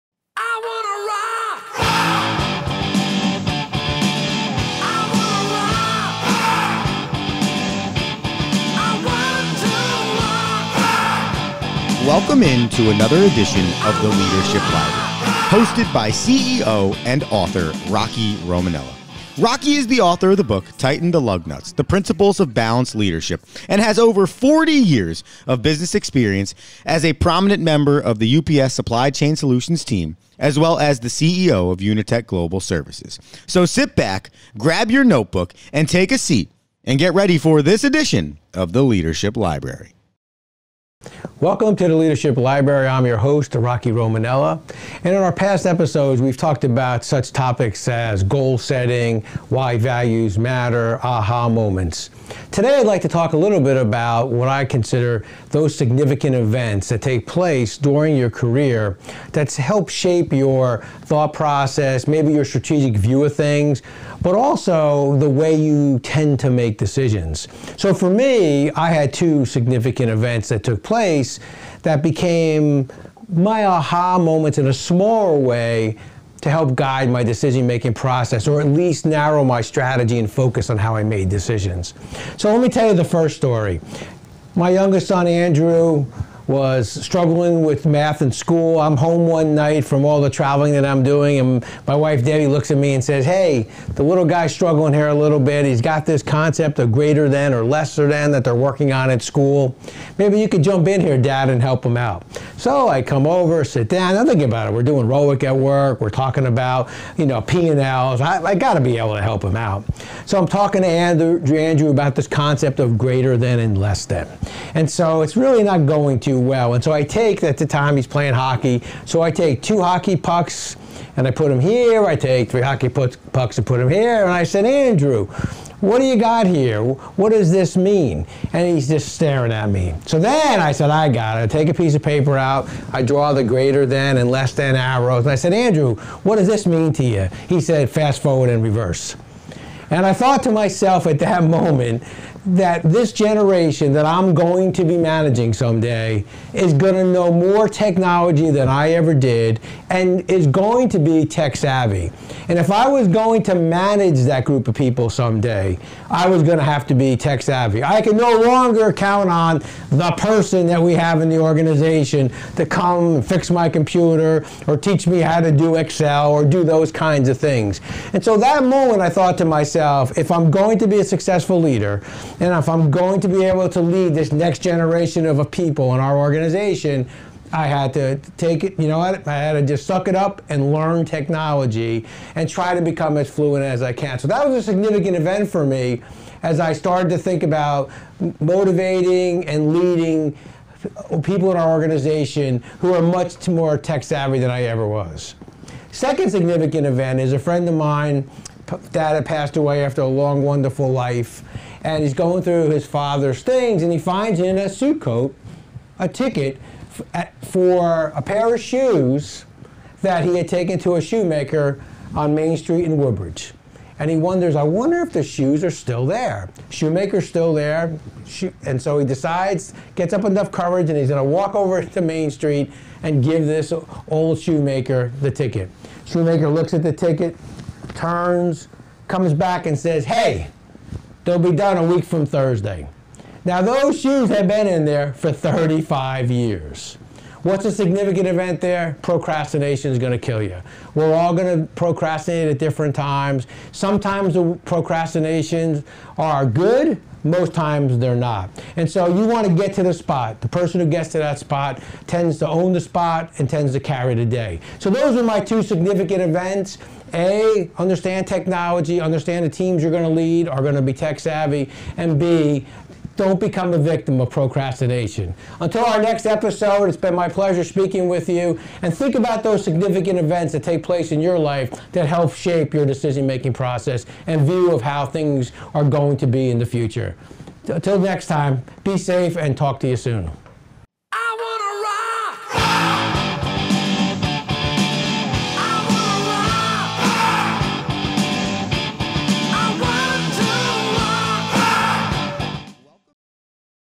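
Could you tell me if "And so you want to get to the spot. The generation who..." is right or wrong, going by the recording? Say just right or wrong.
wrong.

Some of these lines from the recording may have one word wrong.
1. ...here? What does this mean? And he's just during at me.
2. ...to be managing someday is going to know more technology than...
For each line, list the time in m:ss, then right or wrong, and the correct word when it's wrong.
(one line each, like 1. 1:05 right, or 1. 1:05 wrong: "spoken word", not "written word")
1. 2:06 wrong: "staring", not "during"
2. 2:24 right.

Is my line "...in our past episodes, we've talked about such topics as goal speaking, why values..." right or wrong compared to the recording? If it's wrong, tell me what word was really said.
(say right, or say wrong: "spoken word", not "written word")
wrong: "setting", not "speaking".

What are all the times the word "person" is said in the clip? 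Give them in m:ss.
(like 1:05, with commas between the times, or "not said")
2:40, 4:10.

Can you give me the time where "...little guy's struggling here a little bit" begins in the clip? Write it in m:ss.
1:34.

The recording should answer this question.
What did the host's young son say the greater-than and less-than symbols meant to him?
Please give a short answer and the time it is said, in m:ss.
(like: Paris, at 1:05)
Fast forward and reverse, at 2:17.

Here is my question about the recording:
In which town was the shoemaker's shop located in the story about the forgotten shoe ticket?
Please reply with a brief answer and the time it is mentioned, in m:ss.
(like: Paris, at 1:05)
Woodbridge, at 3:32.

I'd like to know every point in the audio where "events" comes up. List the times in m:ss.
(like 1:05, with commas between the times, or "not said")
0:56, 1:10, 3:05, 3:16, 3:58, 4:16, 4:30.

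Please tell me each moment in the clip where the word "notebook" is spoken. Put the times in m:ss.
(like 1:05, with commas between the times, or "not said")
0:35.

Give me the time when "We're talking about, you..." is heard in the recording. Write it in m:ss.
1:45.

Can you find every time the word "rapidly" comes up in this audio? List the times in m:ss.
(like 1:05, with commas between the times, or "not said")
not said.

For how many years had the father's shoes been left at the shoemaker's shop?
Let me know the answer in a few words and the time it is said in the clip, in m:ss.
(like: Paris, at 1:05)
35, at 3:55.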